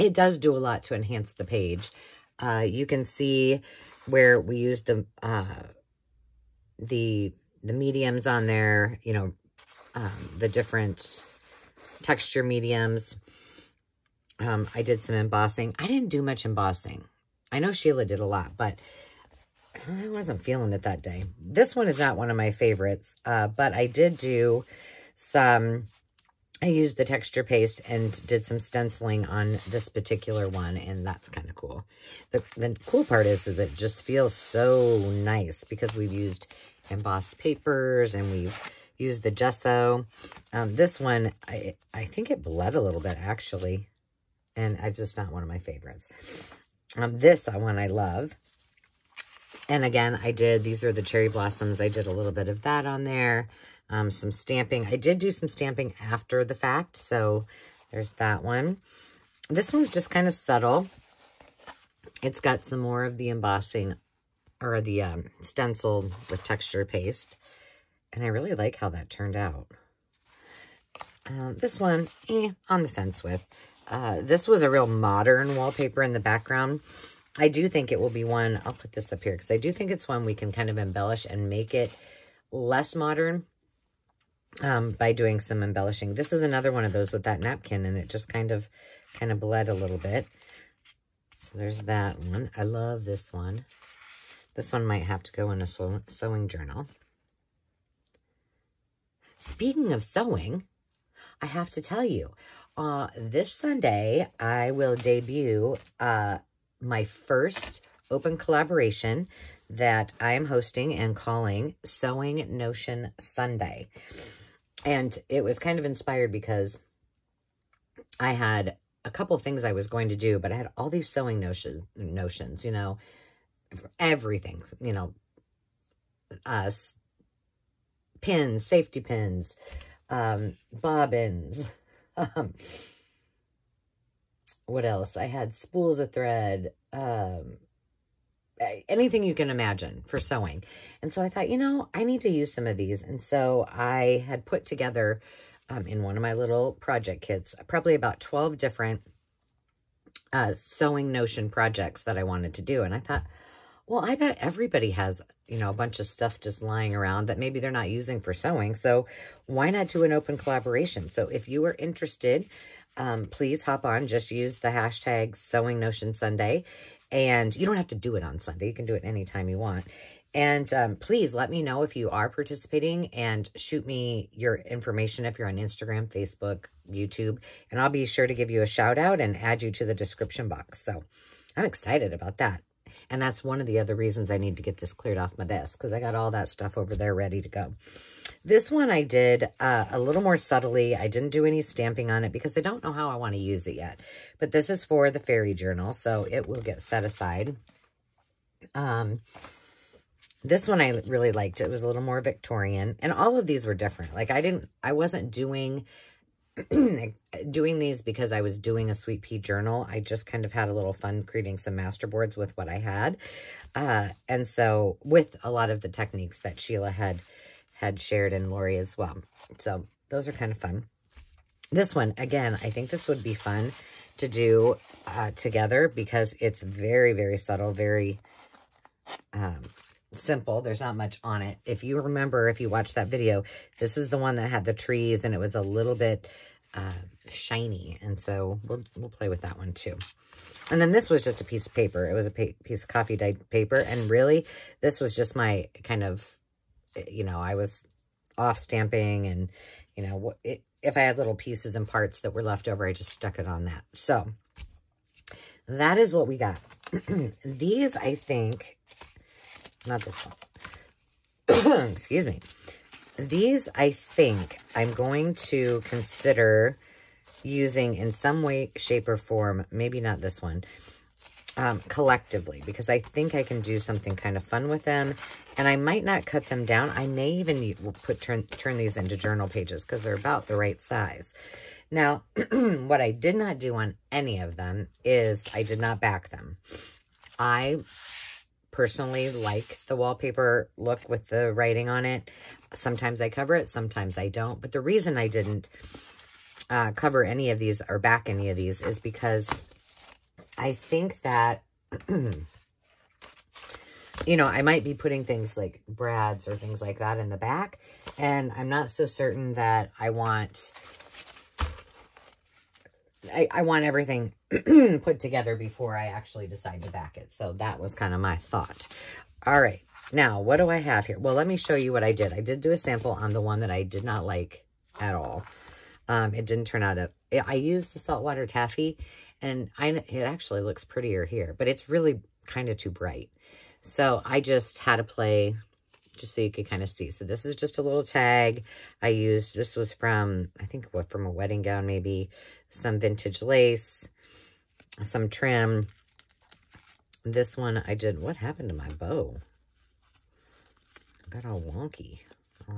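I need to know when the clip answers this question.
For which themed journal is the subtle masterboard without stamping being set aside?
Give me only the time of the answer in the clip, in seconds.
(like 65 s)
195 s.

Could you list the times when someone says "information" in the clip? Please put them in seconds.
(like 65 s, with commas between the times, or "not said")
174 s.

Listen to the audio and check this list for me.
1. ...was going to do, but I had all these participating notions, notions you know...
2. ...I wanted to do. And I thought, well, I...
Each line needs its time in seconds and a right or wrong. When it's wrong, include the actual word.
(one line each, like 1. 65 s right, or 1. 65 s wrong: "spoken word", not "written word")
1. 119 s wrong: "sewing", not "participating"
2. 152 s right.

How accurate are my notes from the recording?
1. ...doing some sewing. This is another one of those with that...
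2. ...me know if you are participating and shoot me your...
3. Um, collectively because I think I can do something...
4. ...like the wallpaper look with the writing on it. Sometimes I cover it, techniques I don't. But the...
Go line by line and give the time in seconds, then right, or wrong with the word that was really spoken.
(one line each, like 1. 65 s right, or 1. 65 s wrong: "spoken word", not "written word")
1. 85 s wrong: "embellishing", not "sewing"
2. 171 s right
3. 271 s right
4. 289 s wrong: "sometimes", not "techniques".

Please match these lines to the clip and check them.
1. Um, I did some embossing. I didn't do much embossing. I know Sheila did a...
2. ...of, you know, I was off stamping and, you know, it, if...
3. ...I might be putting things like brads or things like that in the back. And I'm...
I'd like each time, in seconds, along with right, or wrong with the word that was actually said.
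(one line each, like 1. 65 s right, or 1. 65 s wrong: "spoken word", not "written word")
1. 14 s right
2. 246 s right
3. 304 s right.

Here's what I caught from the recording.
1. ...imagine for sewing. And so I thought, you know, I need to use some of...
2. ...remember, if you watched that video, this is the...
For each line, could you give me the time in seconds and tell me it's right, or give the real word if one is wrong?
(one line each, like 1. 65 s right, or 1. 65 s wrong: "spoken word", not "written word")
1. 139 s right
2. 232 s right.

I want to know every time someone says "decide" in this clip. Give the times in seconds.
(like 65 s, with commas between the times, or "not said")
316 s.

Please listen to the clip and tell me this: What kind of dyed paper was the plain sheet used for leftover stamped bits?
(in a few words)
Coffee dyed.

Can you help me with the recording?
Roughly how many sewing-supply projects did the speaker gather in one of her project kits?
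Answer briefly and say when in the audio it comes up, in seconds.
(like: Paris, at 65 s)
12, at 148 s.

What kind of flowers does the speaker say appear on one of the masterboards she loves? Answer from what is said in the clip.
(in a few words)
Cherry blossoms.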